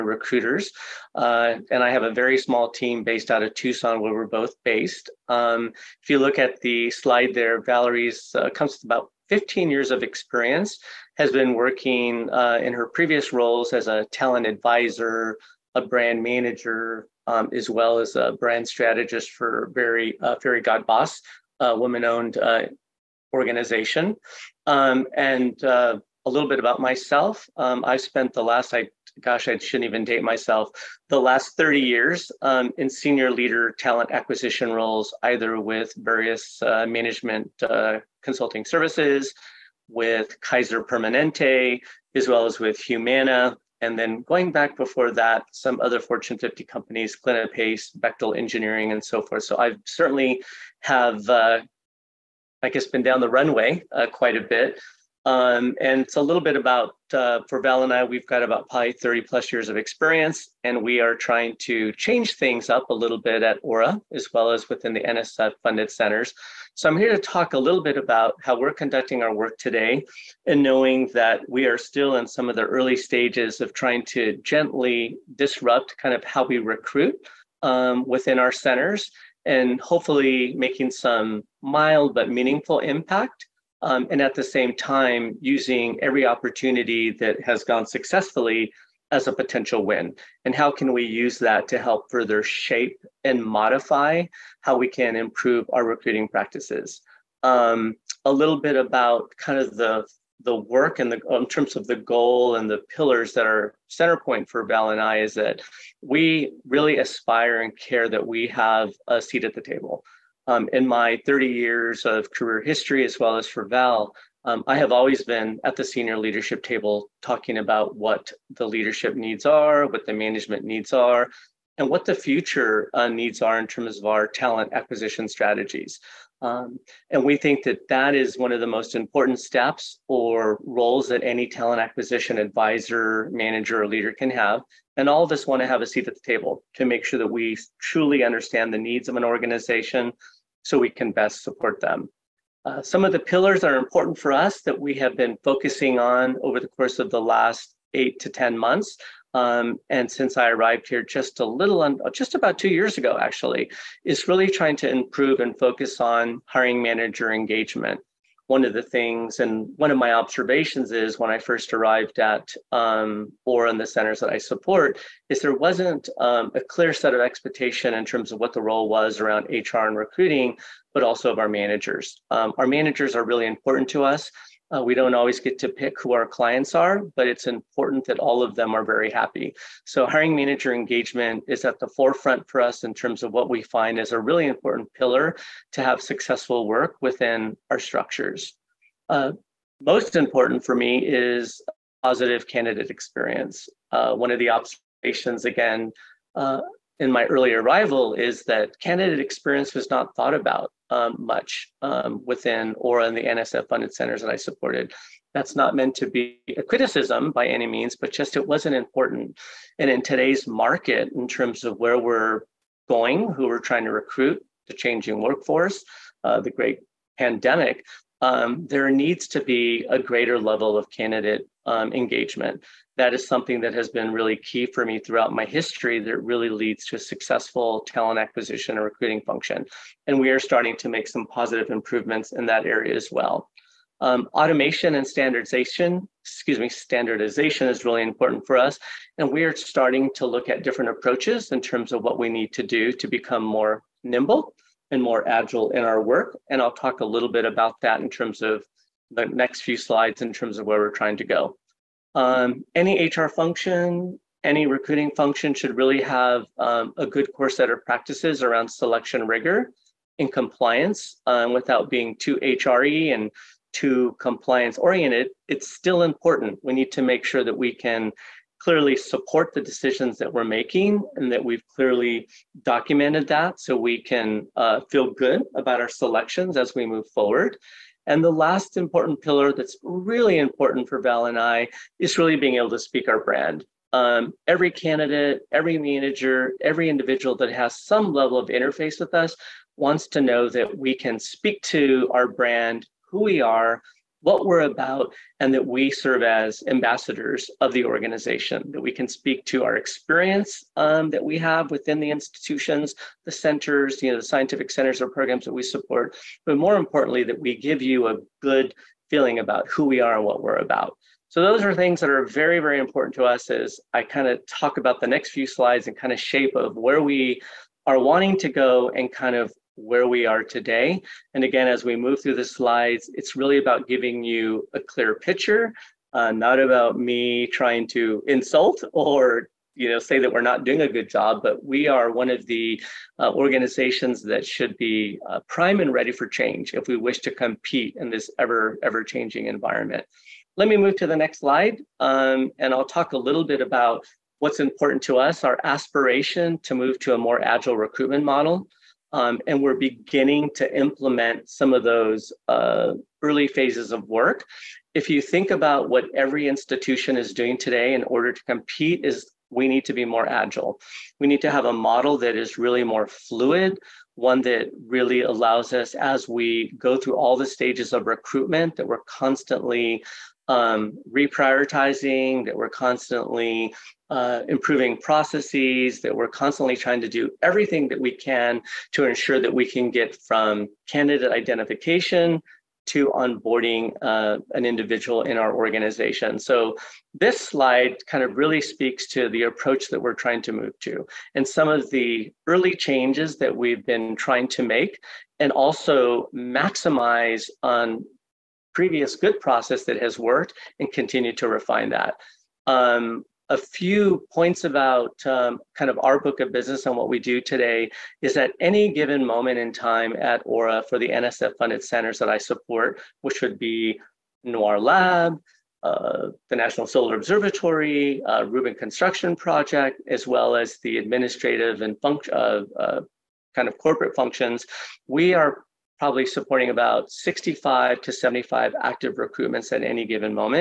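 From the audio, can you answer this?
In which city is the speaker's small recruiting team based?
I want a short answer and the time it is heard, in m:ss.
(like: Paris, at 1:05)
Tucson, at 0:03.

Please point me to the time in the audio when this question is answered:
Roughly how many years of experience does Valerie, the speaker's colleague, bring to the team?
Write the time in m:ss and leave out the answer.
0:09.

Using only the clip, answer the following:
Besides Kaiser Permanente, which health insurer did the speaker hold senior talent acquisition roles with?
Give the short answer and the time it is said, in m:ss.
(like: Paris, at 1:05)
Humana, at 0:42.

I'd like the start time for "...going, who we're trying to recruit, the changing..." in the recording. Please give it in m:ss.
3:32.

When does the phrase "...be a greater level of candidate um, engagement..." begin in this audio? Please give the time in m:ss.
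3:39.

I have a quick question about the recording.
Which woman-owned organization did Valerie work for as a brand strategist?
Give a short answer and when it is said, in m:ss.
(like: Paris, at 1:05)
Fairygodboss, at 0:20.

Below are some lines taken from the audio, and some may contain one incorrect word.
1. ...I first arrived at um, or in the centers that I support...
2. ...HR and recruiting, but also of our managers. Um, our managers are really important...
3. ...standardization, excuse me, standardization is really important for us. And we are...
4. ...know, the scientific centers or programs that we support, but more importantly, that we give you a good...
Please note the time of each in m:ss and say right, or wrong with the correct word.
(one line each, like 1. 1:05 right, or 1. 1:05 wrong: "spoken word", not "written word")
1. 2:41 right
2. 2:49 right
3. 3:55 right
4. 5:04 right.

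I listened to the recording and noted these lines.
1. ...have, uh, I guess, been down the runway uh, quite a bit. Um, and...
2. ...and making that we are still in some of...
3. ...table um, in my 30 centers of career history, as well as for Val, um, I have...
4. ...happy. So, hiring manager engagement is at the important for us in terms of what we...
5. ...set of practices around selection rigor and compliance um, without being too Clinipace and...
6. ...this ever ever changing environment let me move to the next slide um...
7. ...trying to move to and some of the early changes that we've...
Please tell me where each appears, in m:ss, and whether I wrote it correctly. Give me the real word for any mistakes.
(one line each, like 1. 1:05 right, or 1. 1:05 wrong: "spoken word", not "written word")
1. 0:50 right
2. 1:10 wrong: "knowing", not "making"
3. 1:49 wrong: "years", not "centers"
4. 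2:59 wrong: "forefront", not "important"
5. 4:17 wrong: "HRE", not "Clinipace"
6. 5:38 right
7. 6:30 right.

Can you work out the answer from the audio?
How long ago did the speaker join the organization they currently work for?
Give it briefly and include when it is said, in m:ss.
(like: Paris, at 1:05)
about 2 years ago, at 2:32.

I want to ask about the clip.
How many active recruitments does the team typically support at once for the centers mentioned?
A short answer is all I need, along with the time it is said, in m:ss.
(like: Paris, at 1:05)
65 to 75, at 7:07.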